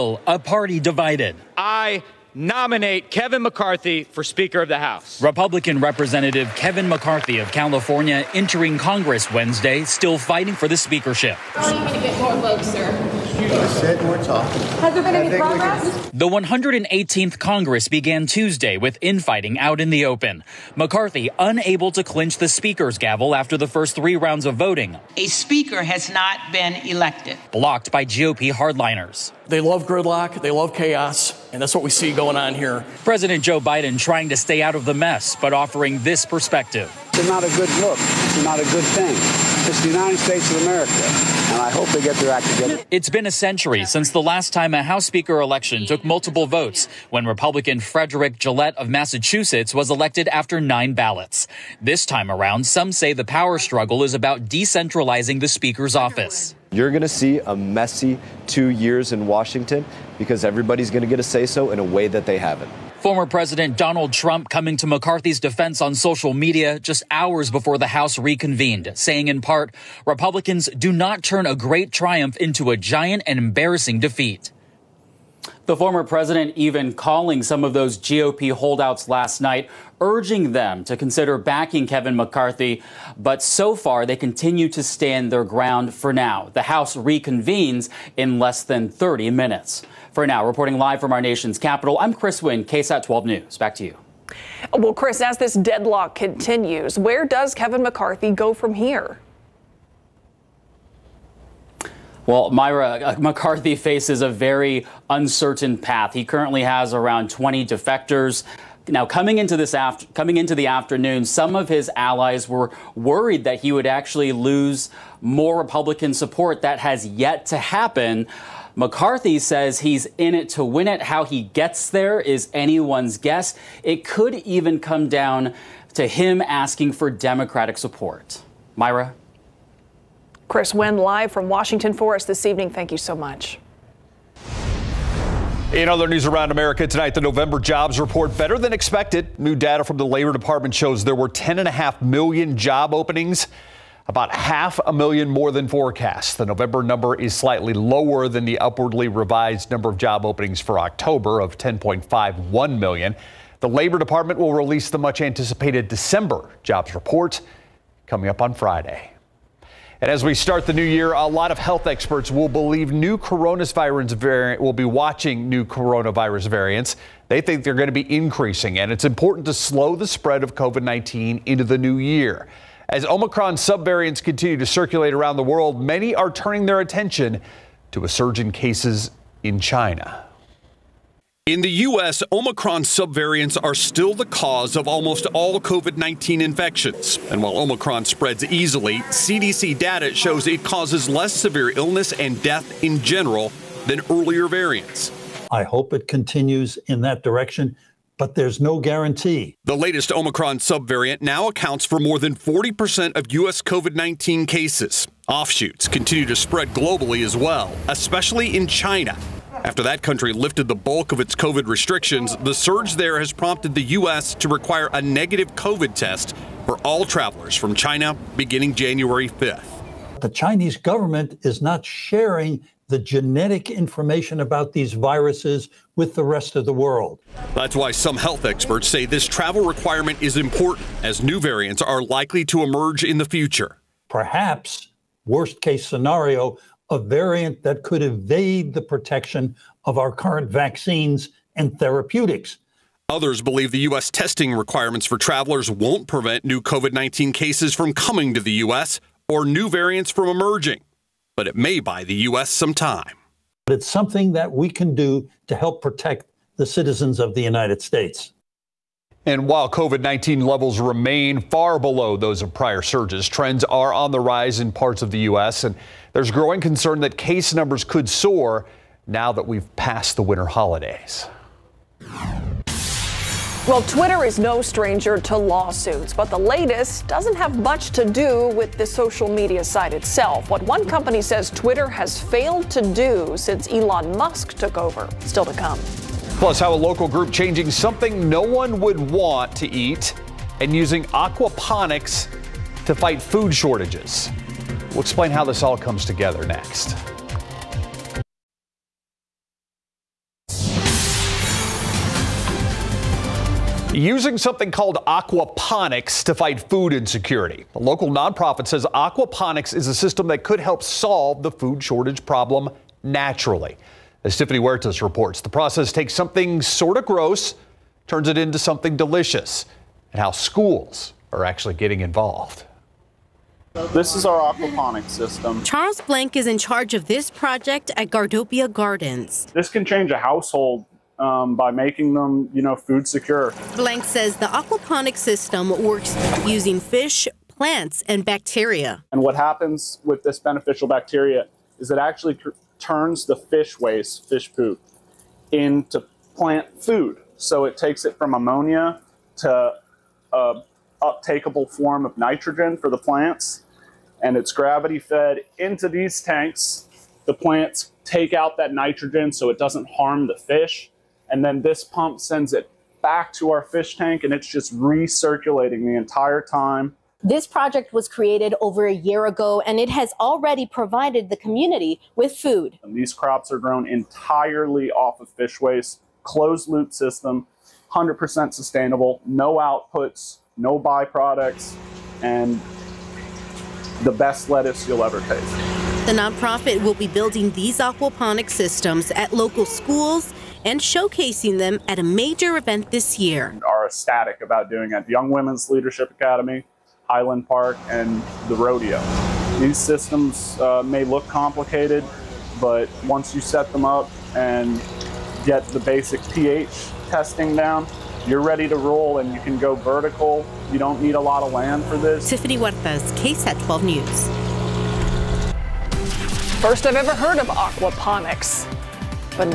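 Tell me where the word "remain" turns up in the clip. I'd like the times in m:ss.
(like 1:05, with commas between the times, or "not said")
4:20.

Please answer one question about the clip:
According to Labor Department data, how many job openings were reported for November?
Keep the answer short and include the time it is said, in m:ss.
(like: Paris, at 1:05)
10.5 million, at 2:21.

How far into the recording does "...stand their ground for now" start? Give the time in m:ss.
1:24.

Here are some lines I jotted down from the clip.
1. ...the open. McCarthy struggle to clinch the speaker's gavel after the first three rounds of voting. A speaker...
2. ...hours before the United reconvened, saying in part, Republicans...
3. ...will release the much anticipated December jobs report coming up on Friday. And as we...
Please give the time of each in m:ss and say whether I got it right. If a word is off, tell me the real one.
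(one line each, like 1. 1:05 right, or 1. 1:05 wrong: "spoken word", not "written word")
1. 0:19 wrong: "unable", not "struggle"
2. 1:07 wrong: "House", not "United"
3. 2:34 right.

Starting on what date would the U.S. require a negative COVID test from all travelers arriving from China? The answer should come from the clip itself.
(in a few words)
January 5th.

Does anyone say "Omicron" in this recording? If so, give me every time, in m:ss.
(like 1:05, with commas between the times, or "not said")
2:53, 3:02, 3:07, 3:20.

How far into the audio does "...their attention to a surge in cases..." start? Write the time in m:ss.
2:56.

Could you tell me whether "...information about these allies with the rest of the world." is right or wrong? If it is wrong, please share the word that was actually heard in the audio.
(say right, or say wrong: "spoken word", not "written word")
wrong: "viruses", not "allies".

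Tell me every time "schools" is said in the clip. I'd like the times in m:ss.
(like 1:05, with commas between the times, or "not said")
5:20, 6:29.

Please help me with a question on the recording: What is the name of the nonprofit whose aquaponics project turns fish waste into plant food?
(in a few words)
Gardopia Gardens.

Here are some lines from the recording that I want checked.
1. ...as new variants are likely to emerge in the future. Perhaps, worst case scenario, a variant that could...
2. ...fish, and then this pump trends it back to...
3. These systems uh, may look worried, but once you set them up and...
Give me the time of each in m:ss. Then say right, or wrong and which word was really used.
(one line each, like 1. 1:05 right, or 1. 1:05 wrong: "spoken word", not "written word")
1. 3:51 right
2. 6:00 wrong: "sends", not "trends"
3. 6:39 wrong: "complicated", not "worried".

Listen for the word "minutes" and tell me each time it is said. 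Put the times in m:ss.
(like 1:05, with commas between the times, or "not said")
1:29.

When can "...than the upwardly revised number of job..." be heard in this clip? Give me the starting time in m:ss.
2:28.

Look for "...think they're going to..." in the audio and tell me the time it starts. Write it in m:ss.
2:47.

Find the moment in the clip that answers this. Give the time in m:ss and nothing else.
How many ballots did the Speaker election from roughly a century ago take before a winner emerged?
0:50.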